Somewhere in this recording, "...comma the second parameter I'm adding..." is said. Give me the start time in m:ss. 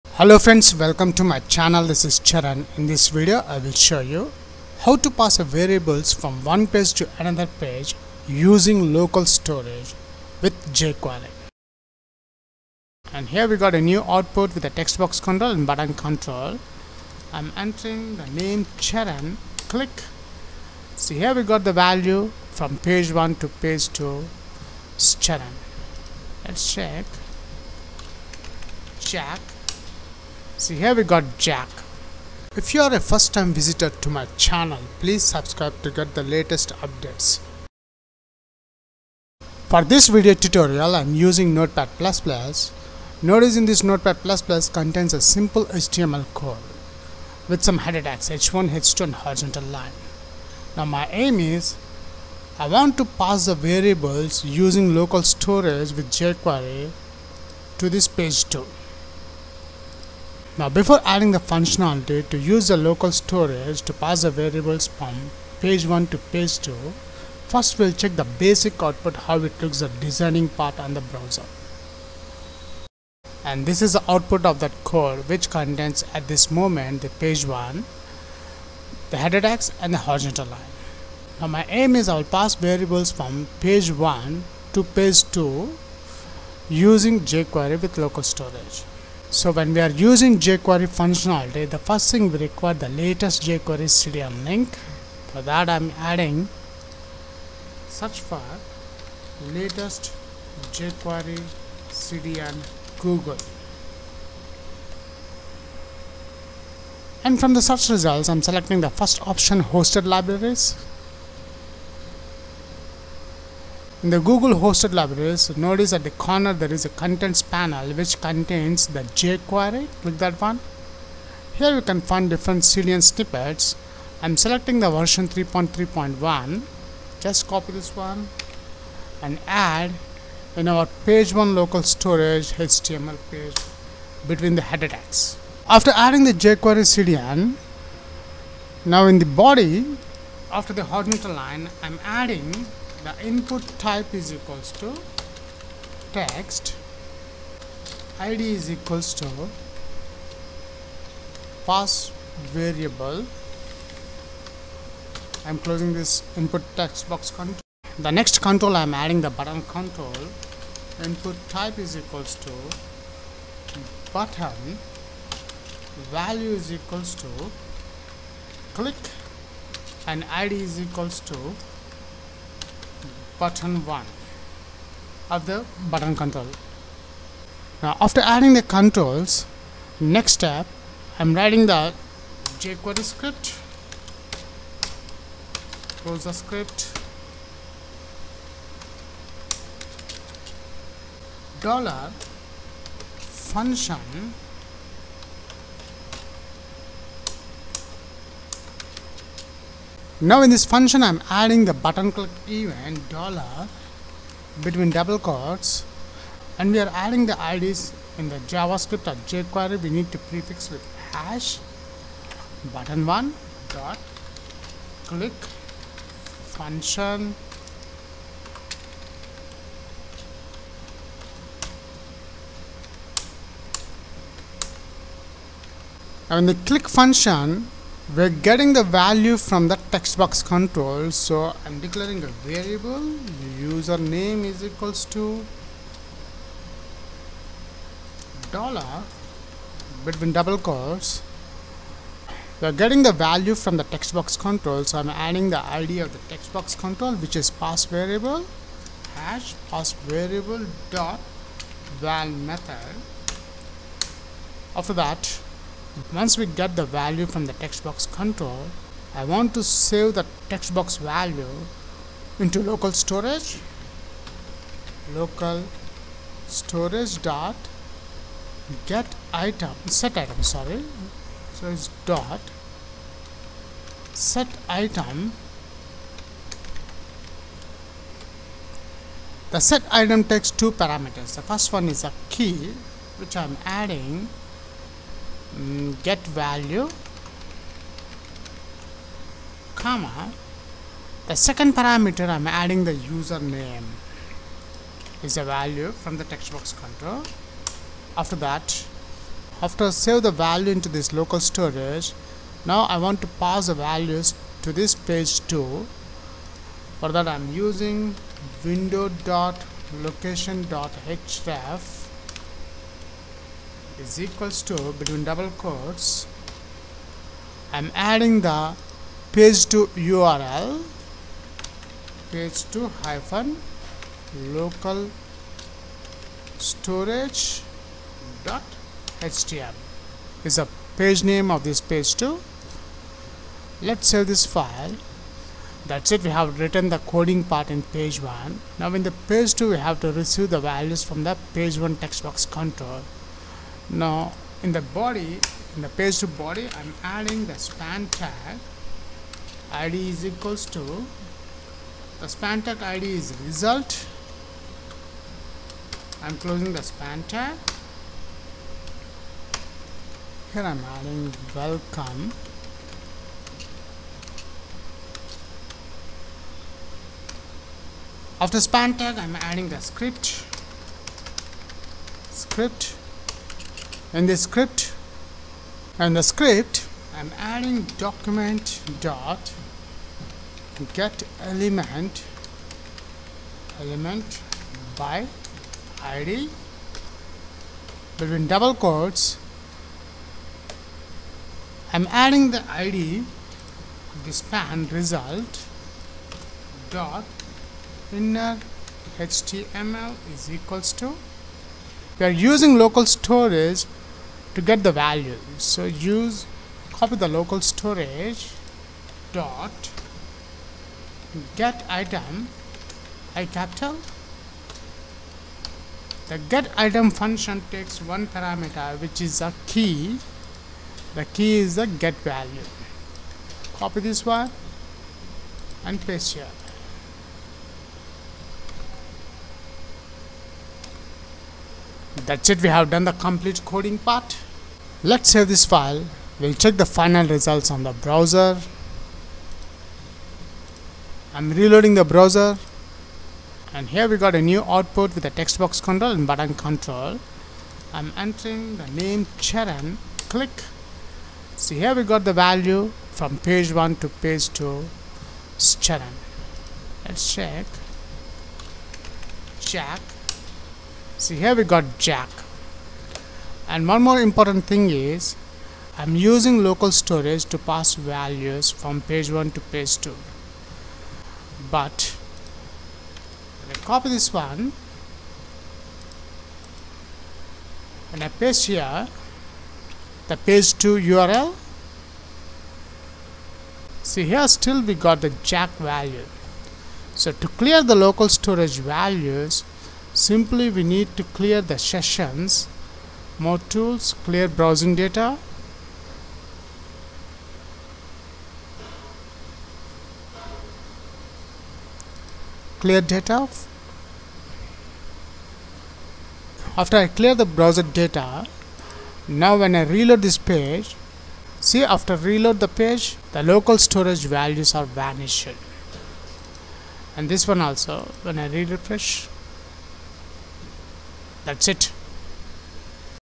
4:49.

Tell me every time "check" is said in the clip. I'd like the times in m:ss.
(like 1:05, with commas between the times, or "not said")
0:26, 1:07, 7:16, 7:37.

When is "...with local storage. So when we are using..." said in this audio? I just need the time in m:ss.
1:27.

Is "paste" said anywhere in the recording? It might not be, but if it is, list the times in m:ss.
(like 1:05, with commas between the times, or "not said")
7:06, 7:58.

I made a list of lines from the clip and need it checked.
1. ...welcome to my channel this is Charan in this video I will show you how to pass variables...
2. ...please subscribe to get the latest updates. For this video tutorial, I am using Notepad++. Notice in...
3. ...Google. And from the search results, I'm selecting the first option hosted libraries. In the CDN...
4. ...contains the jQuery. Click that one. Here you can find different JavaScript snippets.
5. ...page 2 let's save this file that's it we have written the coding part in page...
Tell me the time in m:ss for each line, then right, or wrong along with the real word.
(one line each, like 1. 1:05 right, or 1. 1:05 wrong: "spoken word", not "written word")
1. 0:00 right
2. 0:34 right
3. 1:42 wrong: "Google", not "CDN"
4. 1:58 wrong: "CDN", not "JavaScript"
5. 5:31 right.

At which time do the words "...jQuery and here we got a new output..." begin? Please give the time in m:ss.
0:10.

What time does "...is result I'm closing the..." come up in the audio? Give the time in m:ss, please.
5:53.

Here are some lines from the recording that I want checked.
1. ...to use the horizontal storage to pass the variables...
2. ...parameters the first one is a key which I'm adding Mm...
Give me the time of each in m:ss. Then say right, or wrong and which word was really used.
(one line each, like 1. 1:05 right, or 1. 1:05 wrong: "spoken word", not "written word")
1. 1:02 wrong: "local", not "horizontal"
2. 4:40 right.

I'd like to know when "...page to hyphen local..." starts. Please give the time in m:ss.
5:22.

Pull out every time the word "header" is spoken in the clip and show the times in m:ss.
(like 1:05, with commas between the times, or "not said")
0:47, 1:19, 2:14.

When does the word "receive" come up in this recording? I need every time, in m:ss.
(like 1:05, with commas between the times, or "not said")
5:40.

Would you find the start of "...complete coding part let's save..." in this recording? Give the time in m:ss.
7:13.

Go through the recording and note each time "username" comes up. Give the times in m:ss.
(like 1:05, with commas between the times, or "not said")
3:53, 4:52.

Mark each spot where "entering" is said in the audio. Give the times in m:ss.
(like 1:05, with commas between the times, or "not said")
0:17, 7:28.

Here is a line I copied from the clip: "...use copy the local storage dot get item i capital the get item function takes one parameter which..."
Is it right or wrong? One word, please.
right.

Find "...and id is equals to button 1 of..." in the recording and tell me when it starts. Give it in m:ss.
2:50.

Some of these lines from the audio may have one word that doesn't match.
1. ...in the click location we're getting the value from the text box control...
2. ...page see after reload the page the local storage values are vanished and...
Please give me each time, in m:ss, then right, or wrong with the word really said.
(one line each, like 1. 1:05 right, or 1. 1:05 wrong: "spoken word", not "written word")
1. 3:46 wrong: "function", not "location"
2. 8:30 right.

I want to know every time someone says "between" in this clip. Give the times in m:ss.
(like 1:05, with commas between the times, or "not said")
2:14, 3:24, 4:00, 5:14, 6:28.